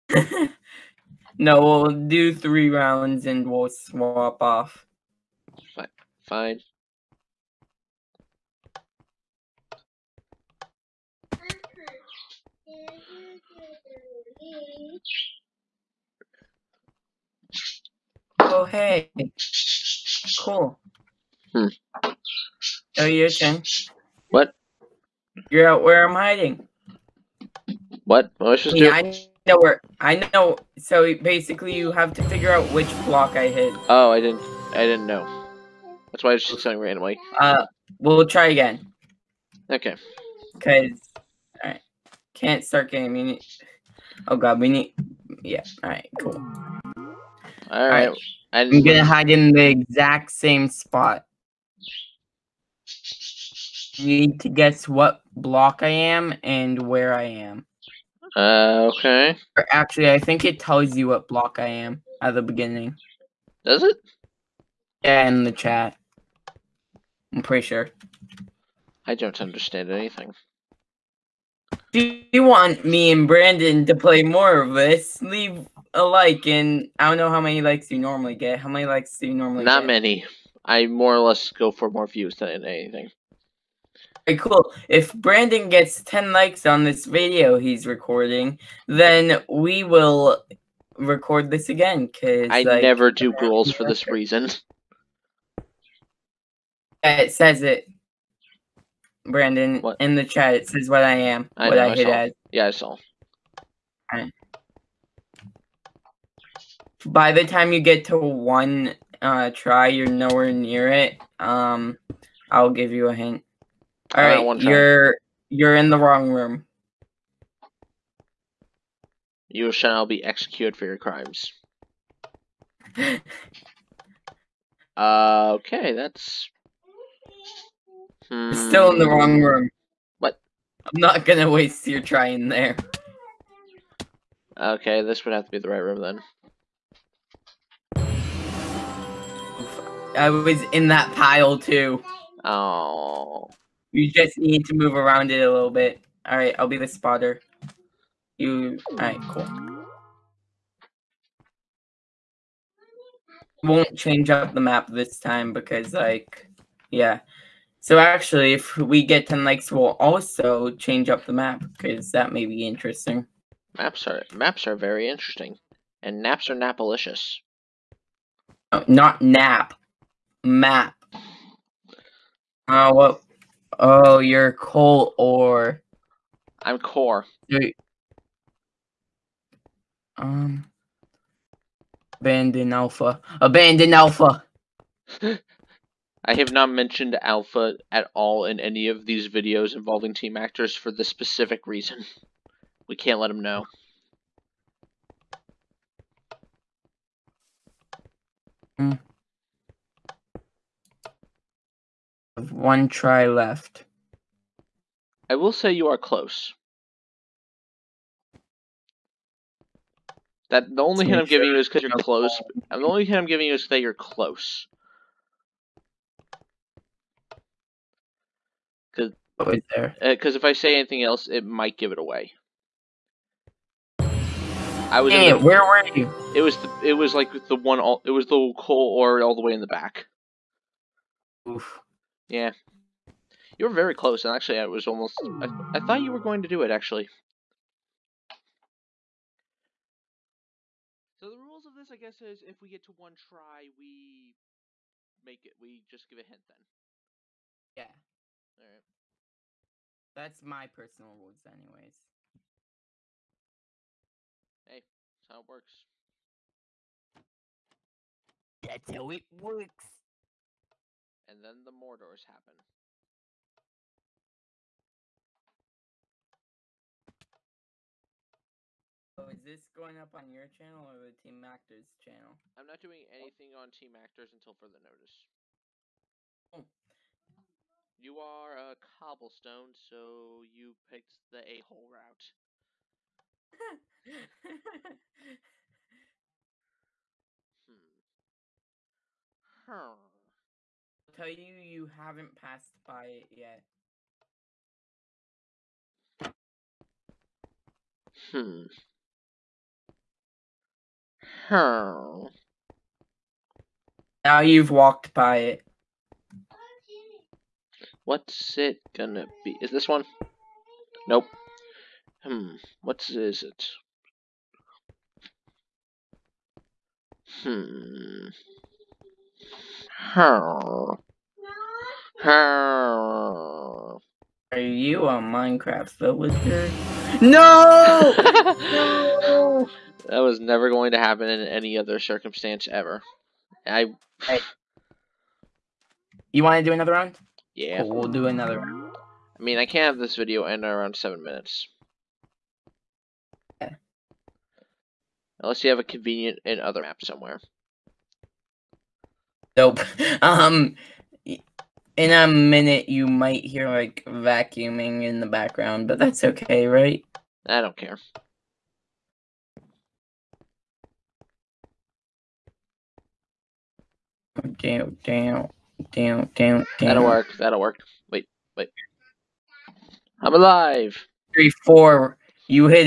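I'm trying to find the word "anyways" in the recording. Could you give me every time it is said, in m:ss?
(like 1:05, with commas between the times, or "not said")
4:11.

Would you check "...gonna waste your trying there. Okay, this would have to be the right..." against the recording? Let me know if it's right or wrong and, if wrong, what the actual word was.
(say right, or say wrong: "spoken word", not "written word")
right.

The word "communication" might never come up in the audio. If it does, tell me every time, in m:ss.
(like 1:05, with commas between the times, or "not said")
not said.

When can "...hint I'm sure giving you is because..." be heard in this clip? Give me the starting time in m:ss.
3:31.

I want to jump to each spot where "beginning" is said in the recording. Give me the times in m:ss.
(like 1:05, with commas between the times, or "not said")
1:02.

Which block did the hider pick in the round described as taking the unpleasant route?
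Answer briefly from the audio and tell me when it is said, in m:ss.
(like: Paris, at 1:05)
cobblestone, at 4:38.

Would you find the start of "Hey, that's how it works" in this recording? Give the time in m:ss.
4:14.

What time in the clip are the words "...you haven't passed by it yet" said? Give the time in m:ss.
4:51.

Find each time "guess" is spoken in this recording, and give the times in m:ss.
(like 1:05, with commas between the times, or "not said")
0:54, 4:01.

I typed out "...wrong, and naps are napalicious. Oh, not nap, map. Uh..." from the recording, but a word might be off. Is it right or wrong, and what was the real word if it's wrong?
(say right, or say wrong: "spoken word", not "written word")
wrong: "interesting", not "wrong".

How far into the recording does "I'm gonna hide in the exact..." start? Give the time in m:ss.
0:48.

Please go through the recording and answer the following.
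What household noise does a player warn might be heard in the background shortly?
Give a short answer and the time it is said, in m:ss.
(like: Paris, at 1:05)
vacuuming, at 5:54.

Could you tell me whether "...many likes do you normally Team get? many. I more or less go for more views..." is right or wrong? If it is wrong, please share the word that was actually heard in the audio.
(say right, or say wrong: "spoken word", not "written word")
wrong: "Not", not "Team".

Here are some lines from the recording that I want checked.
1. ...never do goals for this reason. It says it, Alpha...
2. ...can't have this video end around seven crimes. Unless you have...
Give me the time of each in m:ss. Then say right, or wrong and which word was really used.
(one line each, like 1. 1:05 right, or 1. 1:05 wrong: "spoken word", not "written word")
1. 1:32 wrong: "Brandon", not "Alpha"
2. 5:39 wrong: "minutes", not "crimes".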